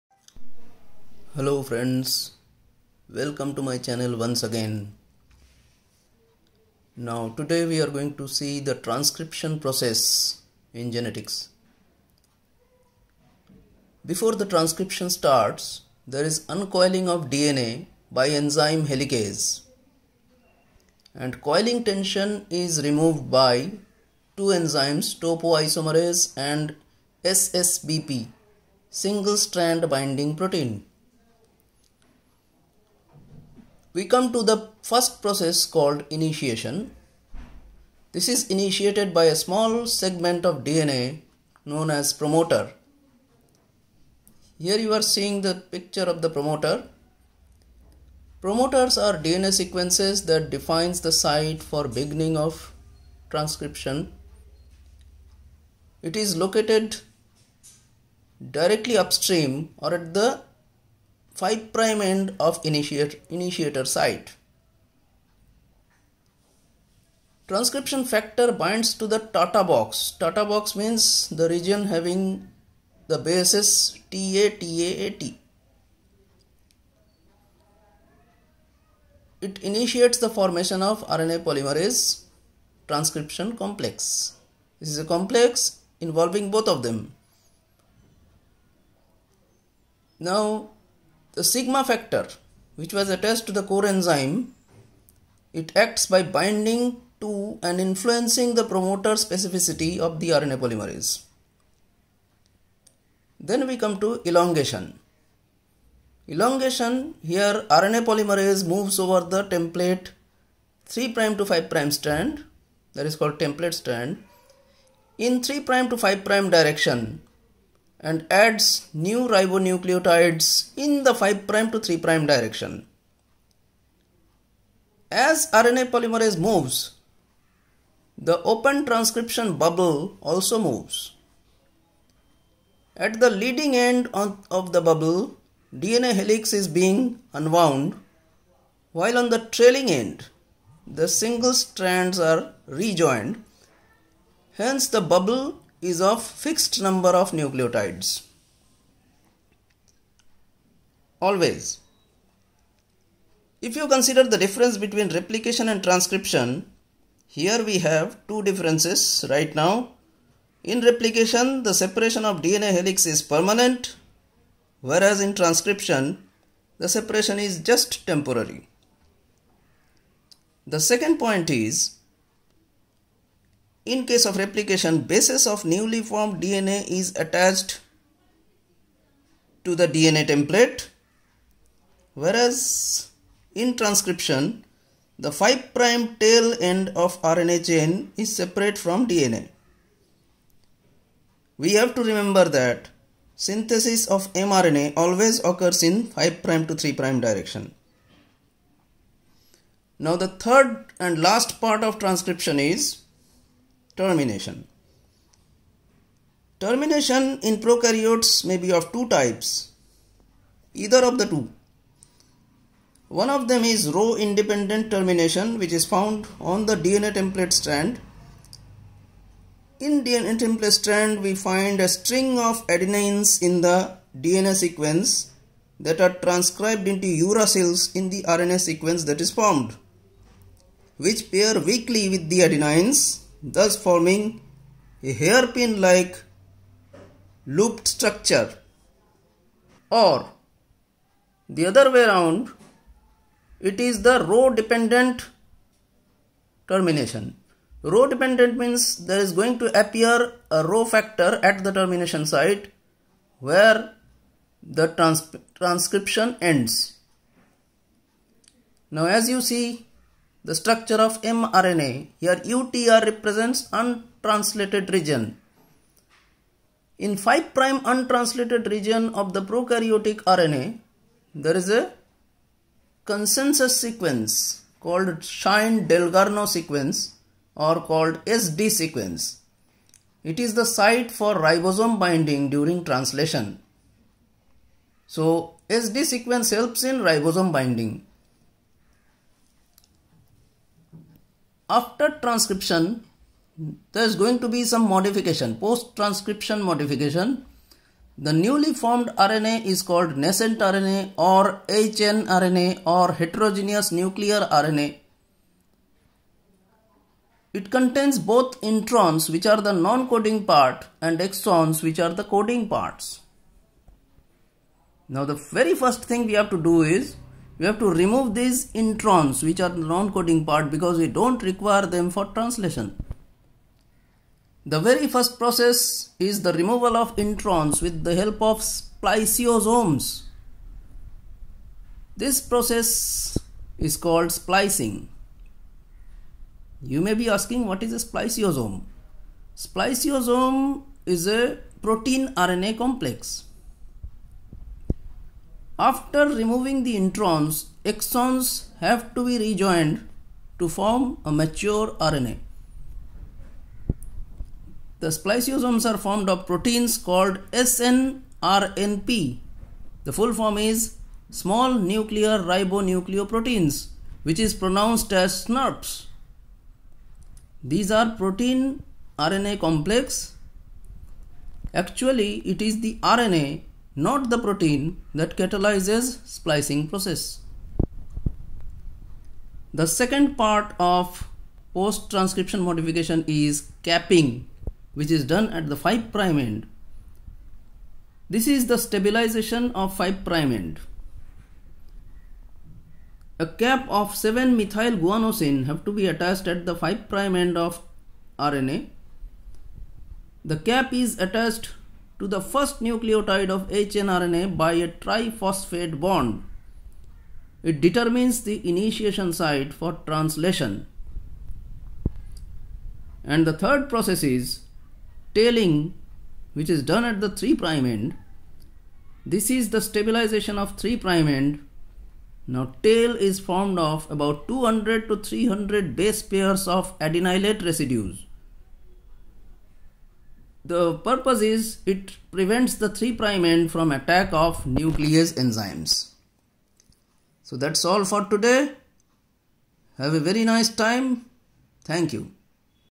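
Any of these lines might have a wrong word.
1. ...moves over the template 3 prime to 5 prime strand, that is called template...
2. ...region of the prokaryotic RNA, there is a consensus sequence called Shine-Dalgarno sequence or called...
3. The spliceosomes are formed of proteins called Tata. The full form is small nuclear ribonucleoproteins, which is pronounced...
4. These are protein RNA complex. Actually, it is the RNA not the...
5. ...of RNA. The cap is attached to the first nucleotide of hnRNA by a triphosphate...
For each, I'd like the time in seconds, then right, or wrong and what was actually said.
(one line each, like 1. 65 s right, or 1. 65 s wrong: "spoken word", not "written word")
1. 108 s right
2. 268 s right
3. 354 s wrong: "SNRNP", not "Tata"
4. 367 s right
5. 397 s right.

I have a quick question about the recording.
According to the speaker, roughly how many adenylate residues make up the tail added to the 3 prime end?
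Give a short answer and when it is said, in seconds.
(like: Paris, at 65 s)
200 to 300, at 424 s.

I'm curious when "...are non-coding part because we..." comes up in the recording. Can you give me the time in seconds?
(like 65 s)
319 s.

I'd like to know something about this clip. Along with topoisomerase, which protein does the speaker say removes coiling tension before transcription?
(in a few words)
Single strand binding protein.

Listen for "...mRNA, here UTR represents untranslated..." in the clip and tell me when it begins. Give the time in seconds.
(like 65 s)
261 s.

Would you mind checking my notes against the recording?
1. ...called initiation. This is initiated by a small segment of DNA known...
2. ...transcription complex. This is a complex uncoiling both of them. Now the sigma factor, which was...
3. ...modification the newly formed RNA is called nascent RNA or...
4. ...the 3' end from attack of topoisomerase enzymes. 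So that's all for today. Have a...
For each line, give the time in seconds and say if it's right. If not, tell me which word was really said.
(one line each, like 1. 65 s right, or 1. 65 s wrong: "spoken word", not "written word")
1. 35 s right
2. 82 s wrong: "involving", not "uncoiling"
3. 296 s right
4. 432 s wrong: "nuclease", not "topoisomerase".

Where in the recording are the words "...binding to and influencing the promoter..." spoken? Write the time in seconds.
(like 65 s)
96 s.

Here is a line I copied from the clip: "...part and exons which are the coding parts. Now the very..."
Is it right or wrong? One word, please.
right.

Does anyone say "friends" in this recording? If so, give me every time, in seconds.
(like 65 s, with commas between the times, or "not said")
1 s.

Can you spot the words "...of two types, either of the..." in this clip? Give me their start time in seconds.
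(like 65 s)
208 s.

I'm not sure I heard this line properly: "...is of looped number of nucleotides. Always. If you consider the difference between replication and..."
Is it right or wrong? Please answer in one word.
wrong.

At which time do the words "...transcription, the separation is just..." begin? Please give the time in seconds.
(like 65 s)
165 s.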